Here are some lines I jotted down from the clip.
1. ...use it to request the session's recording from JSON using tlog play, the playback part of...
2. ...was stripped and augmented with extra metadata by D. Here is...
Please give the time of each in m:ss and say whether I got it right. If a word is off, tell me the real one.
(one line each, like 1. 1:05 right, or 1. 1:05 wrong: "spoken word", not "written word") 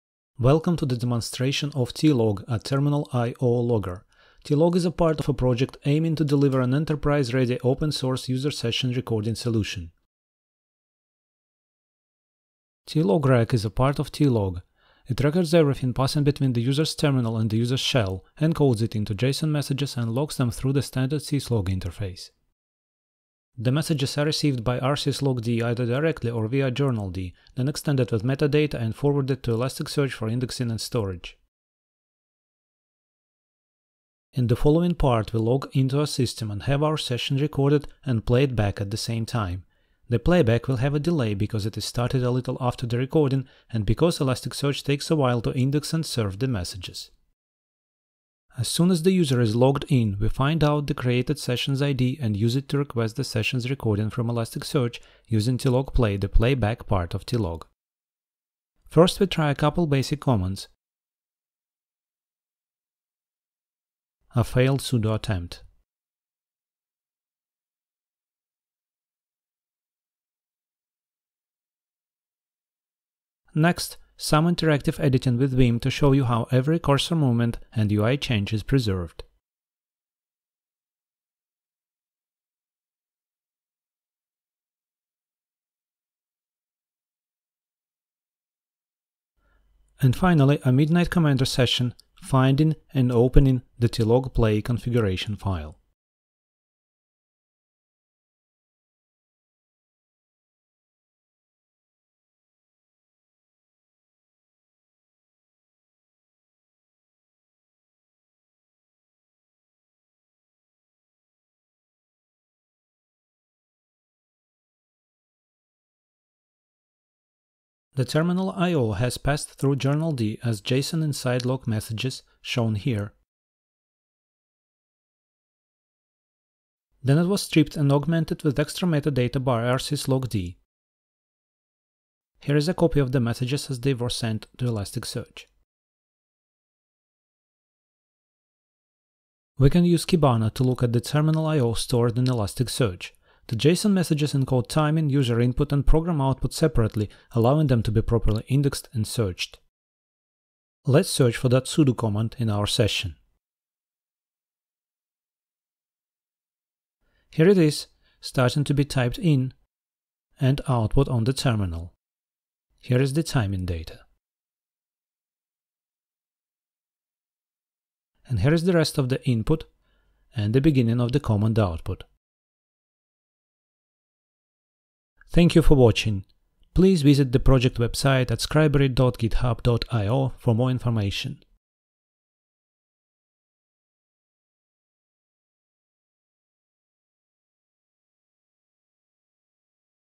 1. 0:52 wrong: "Elasticsearch", not "JSON"
2. 2:07 right.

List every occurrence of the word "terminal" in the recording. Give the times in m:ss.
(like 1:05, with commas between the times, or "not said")
0:02, 0:16, 1:58, 2:21, 2:41.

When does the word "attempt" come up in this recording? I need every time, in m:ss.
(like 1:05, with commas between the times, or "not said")
1:05.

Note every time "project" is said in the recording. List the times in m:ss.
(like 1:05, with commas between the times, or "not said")
0:05, 2:57.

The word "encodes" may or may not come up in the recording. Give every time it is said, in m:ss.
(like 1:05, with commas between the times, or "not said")
0:18, 2:24.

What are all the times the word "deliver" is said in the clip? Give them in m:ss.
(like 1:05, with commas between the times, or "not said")
0:06.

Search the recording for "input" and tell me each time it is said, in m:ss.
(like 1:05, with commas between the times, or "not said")
2:25, 2:49.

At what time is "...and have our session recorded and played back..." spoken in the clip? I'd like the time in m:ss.
0:36.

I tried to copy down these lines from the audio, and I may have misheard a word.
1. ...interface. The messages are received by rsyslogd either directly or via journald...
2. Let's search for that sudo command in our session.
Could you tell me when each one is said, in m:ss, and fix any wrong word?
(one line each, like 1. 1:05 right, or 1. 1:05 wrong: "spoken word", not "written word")
1. 0:21 right
2. 2:30 right.